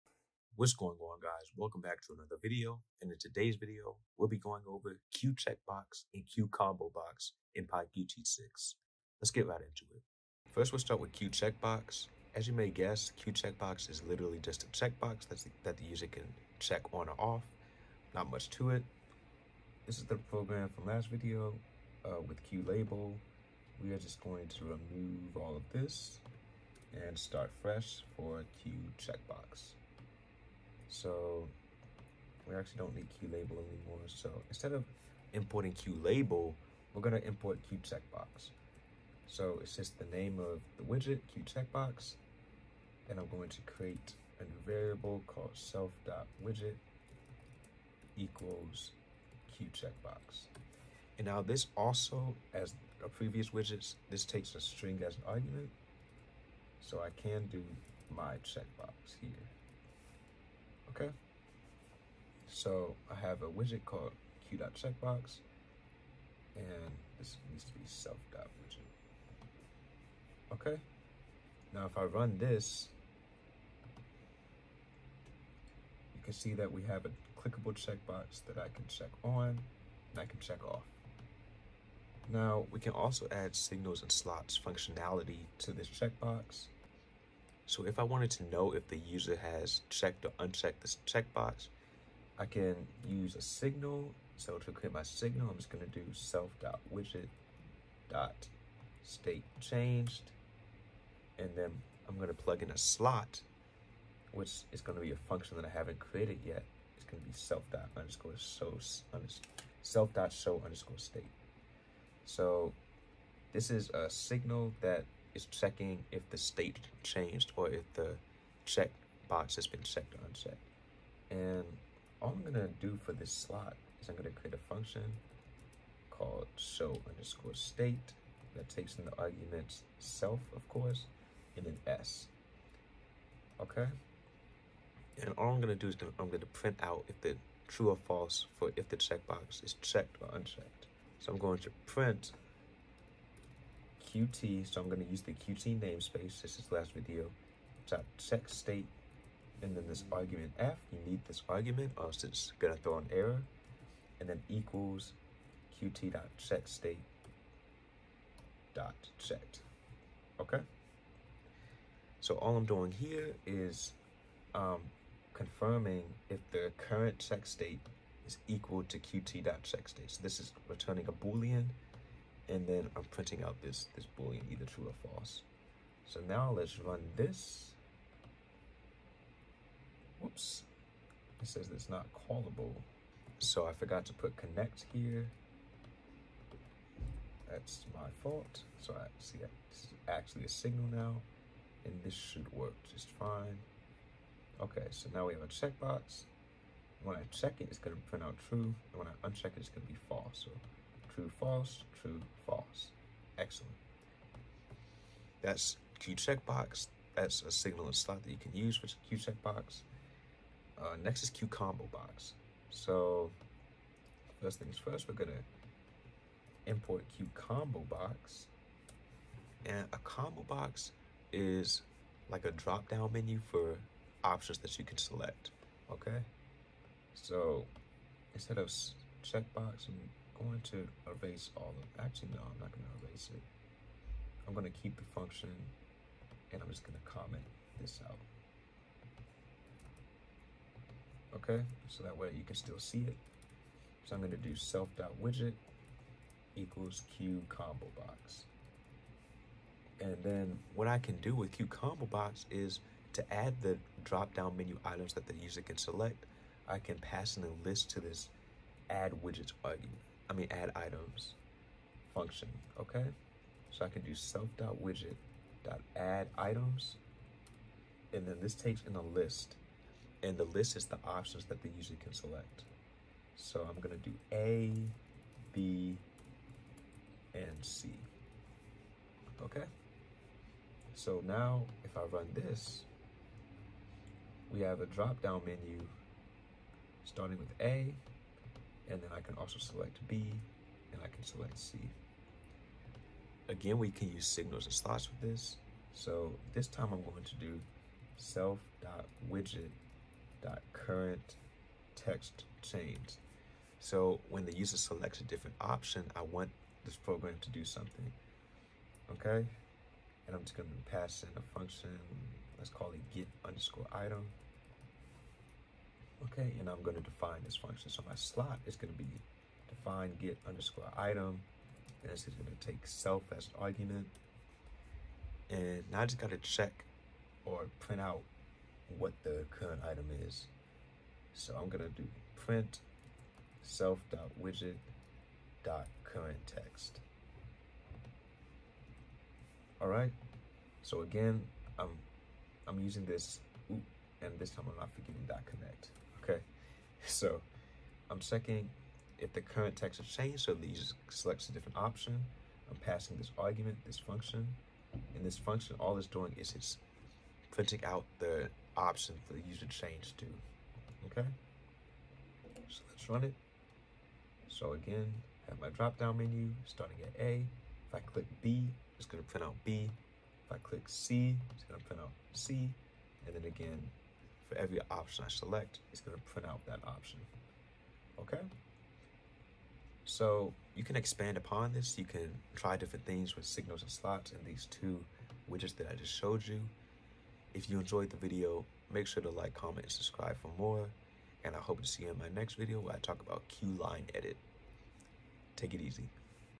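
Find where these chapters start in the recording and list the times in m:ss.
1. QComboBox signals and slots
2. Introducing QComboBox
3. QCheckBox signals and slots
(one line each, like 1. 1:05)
1. 4:52
2. 3:31
3. 1:22.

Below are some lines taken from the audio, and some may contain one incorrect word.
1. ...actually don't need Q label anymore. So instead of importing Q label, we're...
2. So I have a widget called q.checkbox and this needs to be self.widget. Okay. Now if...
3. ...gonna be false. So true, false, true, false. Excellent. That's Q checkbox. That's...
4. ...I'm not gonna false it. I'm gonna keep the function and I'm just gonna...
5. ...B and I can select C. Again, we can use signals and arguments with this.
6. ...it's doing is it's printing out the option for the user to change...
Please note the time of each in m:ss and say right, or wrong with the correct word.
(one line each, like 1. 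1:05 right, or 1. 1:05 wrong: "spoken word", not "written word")
1. 0:32 right
2. 1:02 right
3. 3:19 right
4. 3:52 wrong: "erase", not "false"
5. 4:50 wrong: "slots", not "arguments"
6. 5:55 right.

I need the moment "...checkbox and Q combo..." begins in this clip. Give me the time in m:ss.
0:05.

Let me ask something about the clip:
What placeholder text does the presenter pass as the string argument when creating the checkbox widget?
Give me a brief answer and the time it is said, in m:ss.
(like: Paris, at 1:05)
My checkbox, at 0:58.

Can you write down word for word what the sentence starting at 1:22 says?
Now we can also add signals and slots functionality to this checkbox.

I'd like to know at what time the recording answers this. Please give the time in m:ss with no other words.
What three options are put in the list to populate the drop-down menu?
4:34.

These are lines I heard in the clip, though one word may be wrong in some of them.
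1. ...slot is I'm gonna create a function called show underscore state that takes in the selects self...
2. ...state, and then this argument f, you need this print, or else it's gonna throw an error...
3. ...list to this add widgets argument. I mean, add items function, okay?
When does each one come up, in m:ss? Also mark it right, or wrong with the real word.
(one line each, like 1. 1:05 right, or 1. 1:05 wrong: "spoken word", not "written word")
1. 2:03 wrong: "arguments", not "selects"
2. 2:28 wrong: "argument", not "print"
3. 4:17 right.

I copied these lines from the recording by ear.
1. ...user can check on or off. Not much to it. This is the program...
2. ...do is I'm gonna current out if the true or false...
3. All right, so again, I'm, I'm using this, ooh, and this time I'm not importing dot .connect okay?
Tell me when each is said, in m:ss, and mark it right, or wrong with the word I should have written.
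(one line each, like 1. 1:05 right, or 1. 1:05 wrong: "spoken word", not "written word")
1. 0:15 right
2. 2:15 wrong: "print", not "current"
3. 5:39 wrong: "forgetting", not "importing".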